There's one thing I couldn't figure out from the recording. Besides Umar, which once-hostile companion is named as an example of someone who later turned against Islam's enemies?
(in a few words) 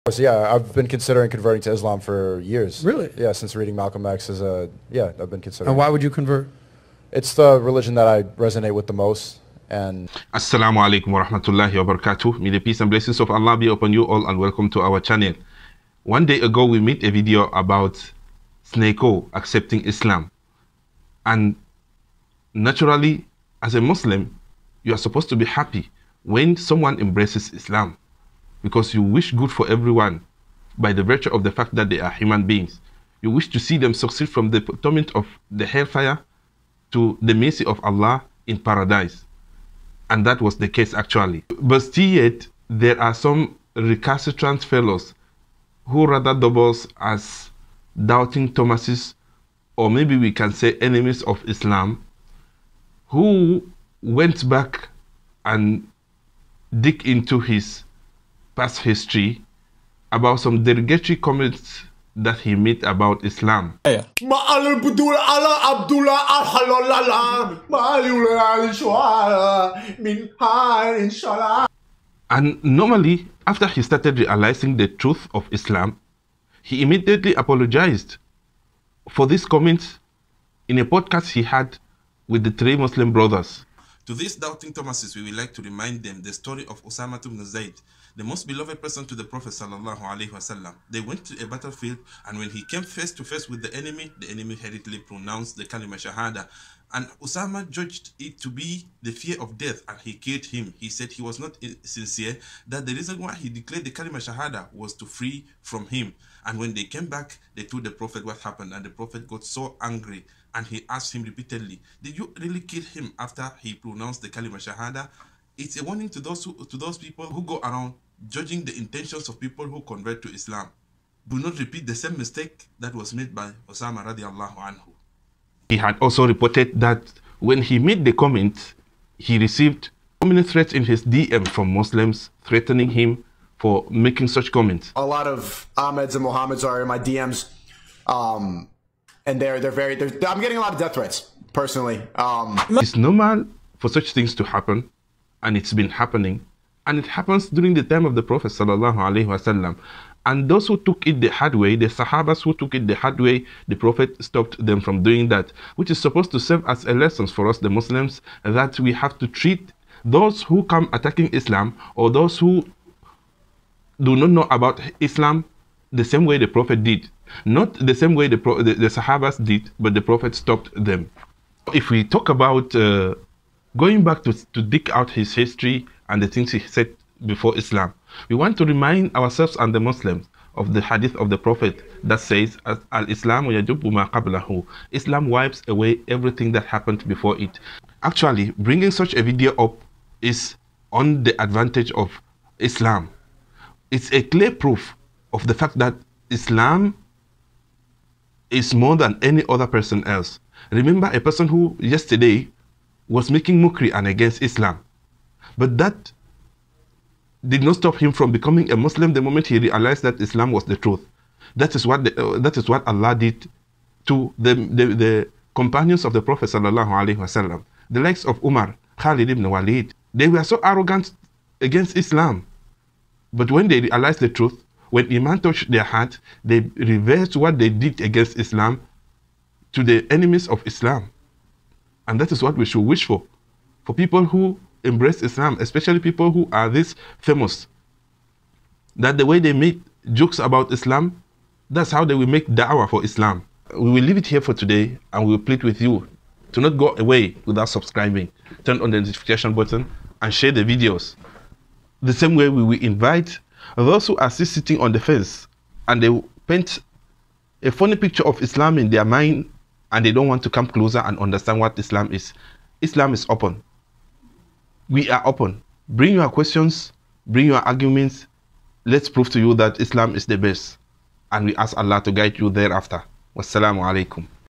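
Khalid ibn Walid.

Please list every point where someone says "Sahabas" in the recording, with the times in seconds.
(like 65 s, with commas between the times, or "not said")
151 s, 168 s.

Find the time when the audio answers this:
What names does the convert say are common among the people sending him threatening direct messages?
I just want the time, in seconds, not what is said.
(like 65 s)
135 s.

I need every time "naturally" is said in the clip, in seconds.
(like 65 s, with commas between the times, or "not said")
22 s.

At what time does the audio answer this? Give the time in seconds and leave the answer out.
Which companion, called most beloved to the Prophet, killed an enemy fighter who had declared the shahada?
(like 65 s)
86 s.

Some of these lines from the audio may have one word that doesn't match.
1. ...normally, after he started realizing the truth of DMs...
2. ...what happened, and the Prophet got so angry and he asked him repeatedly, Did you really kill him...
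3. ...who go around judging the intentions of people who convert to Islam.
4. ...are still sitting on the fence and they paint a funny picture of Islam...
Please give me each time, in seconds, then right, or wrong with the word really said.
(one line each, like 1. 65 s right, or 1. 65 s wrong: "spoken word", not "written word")
1. 72 s wrong: "Islam", not "DMs"
2. 108 s right
3. 117 s right
4. 254 s right.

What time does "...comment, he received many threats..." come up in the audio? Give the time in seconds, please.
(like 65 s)
128 s.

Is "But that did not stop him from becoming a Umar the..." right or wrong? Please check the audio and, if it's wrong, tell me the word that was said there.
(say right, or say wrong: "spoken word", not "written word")
wrong: "Muslim", not "Umar".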